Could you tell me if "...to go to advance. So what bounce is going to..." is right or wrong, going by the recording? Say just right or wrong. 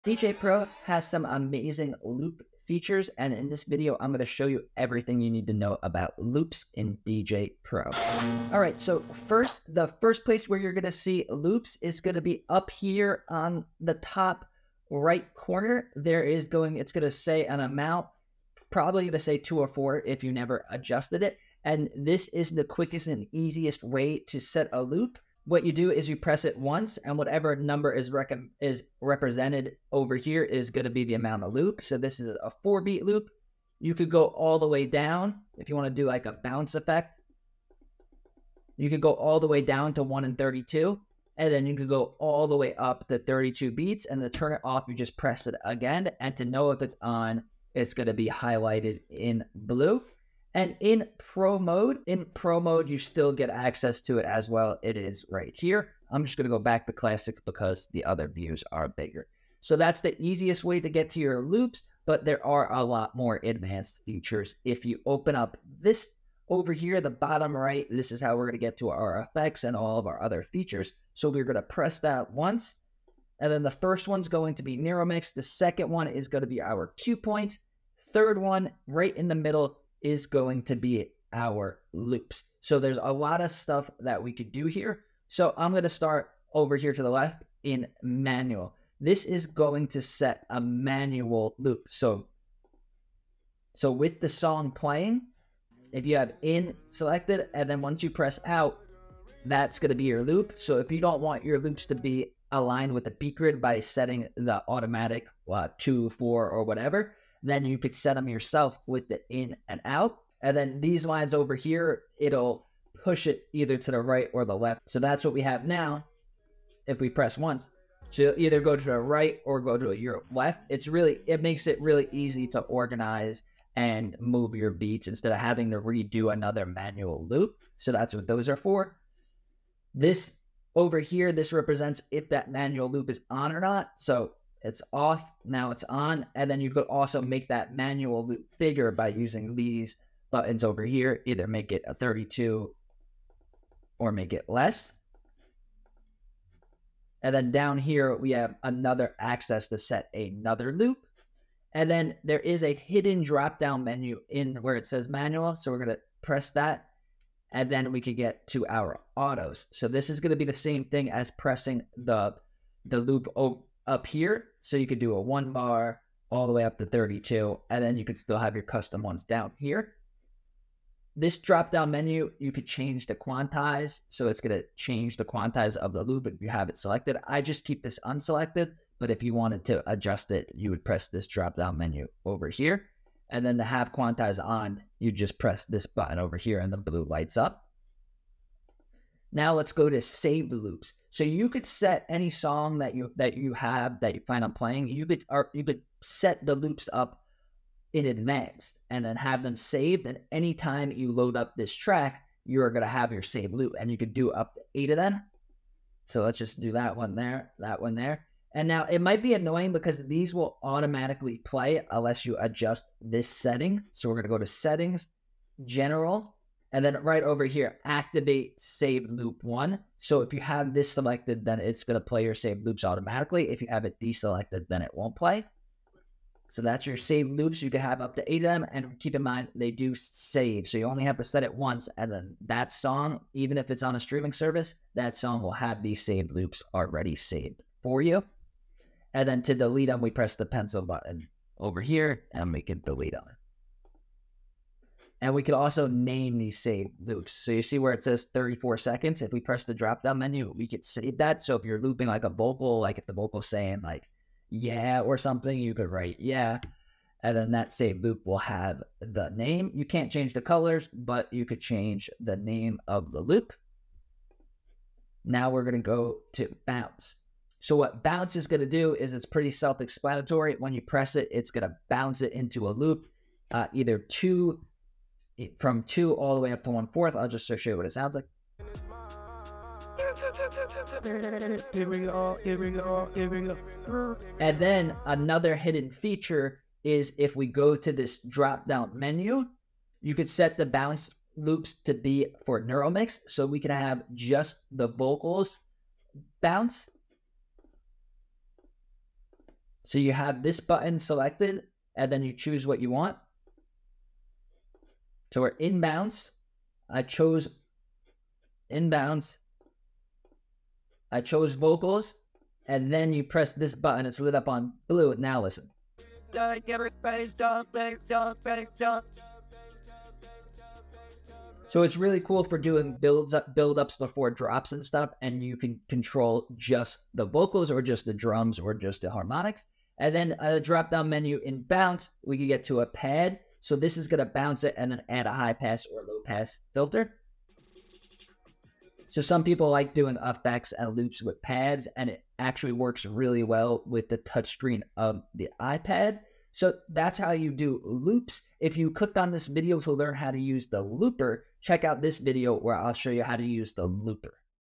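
wrong.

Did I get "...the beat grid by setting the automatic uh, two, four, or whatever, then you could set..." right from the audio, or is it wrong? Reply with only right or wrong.
right.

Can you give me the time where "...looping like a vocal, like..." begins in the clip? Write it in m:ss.
4:11.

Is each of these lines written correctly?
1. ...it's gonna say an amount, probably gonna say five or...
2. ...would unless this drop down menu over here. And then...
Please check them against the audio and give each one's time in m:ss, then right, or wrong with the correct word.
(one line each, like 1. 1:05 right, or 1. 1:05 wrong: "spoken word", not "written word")
1. 0:16 wrong: "two", not "five"
2. 3:00 wrong: "press", not "unless".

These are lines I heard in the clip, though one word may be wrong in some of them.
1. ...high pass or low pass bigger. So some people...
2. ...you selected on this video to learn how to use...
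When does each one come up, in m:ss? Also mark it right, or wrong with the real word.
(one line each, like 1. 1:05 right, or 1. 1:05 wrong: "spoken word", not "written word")
1. 5:35 wrong: "filter", not "bigger"
2. 5:48 wrong: "clicked", not "selected".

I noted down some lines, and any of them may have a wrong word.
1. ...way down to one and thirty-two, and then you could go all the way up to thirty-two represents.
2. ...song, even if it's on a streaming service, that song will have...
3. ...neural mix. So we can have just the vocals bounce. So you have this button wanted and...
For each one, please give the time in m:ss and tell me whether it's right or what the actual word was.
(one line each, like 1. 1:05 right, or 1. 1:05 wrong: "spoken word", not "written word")
1. 0:39 wrong: "beats", not "represents"
2. 3:52 right
3. 4:52 wrong: "selected", not "wanted".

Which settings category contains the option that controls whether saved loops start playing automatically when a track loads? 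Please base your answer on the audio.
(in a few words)
General.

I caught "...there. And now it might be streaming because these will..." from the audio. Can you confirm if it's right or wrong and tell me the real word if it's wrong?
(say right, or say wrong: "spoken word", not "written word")
wrong: "annoying", not "streaming".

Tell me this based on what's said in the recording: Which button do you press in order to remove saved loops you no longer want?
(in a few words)
pencil button.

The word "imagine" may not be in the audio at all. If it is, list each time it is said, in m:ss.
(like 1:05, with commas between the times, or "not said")
not said.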